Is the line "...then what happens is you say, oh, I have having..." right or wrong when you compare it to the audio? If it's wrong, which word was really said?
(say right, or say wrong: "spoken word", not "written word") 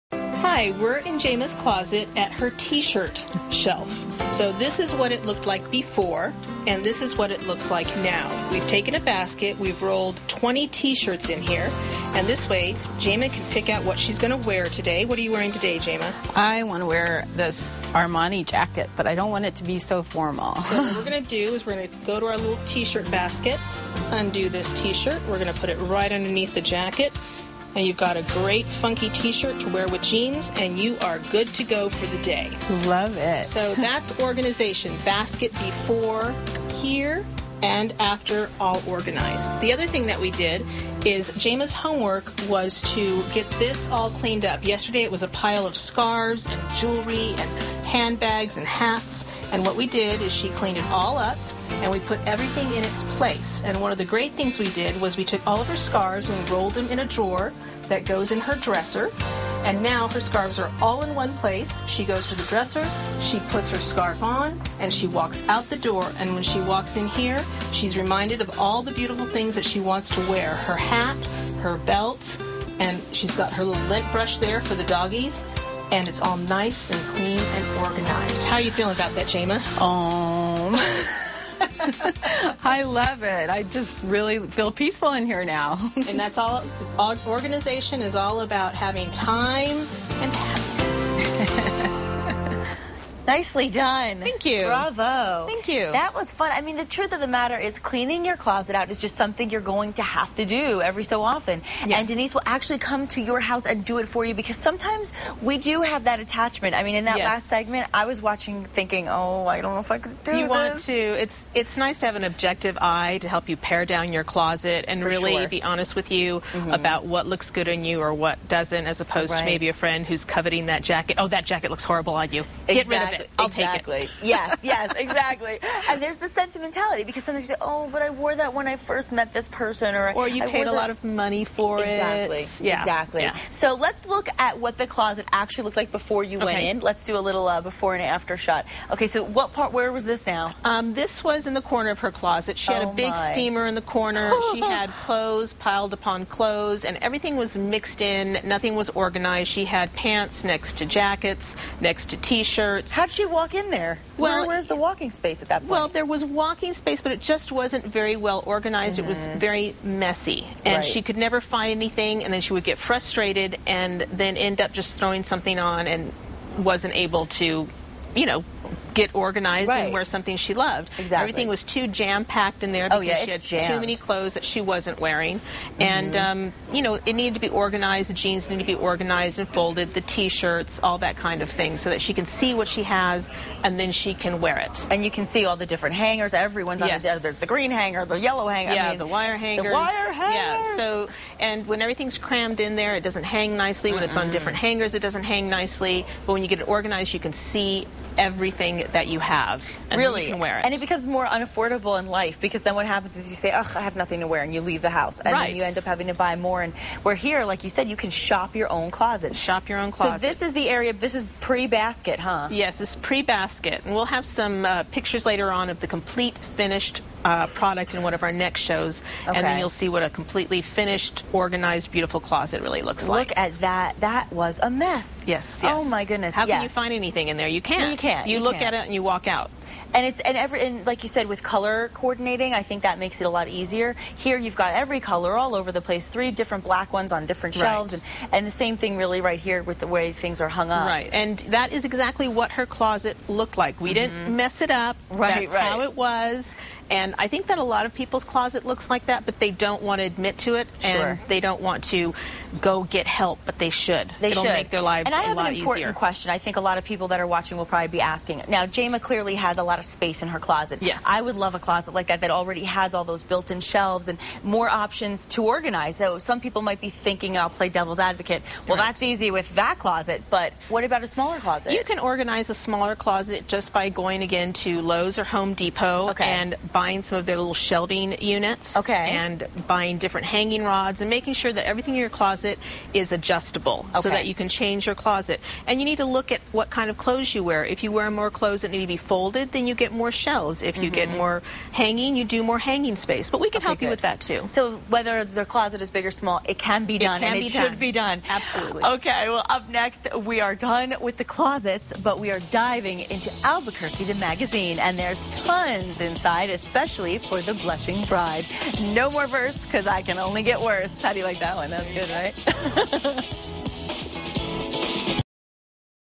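wrong: "nothing", not "having".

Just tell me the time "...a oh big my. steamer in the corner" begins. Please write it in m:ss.
2:22.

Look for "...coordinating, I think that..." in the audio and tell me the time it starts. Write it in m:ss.
3:51.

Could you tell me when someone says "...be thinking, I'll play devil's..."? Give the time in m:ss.
4:26.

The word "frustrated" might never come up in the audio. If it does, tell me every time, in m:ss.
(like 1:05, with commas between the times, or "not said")
2:42.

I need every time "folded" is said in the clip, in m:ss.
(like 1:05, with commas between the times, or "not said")
2:59, 4:48.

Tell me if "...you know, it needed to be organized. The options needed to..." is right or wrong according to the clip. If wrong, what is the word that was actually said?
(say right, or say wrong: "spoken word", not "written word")
wrong: "jeans", not "options".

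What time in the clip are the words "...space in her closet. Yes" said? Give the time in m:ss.
4:19.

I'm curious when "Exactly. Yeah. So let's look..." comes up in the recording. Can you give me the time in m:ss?
2:12.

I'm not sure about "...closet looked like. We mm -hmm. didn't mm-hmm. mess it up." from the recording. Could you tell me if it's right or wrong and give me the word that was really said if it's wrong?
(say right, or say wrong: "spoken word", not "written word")
right.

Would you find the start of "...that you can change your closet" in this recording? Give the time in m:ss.
4:44.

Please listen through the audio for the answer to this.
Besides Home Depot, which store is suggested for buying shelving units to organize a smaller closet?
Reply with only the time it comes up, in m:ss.
4:34.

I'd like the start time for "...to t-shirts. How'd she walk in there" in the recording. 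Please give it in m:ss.
2:32.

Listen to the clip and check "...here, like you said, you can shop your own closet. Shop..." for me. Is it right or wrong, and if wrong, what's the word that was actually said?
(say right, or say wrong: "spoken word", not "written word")
right.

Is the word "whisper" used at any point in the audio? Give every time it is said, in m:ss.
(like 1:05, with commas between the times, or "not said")
not said.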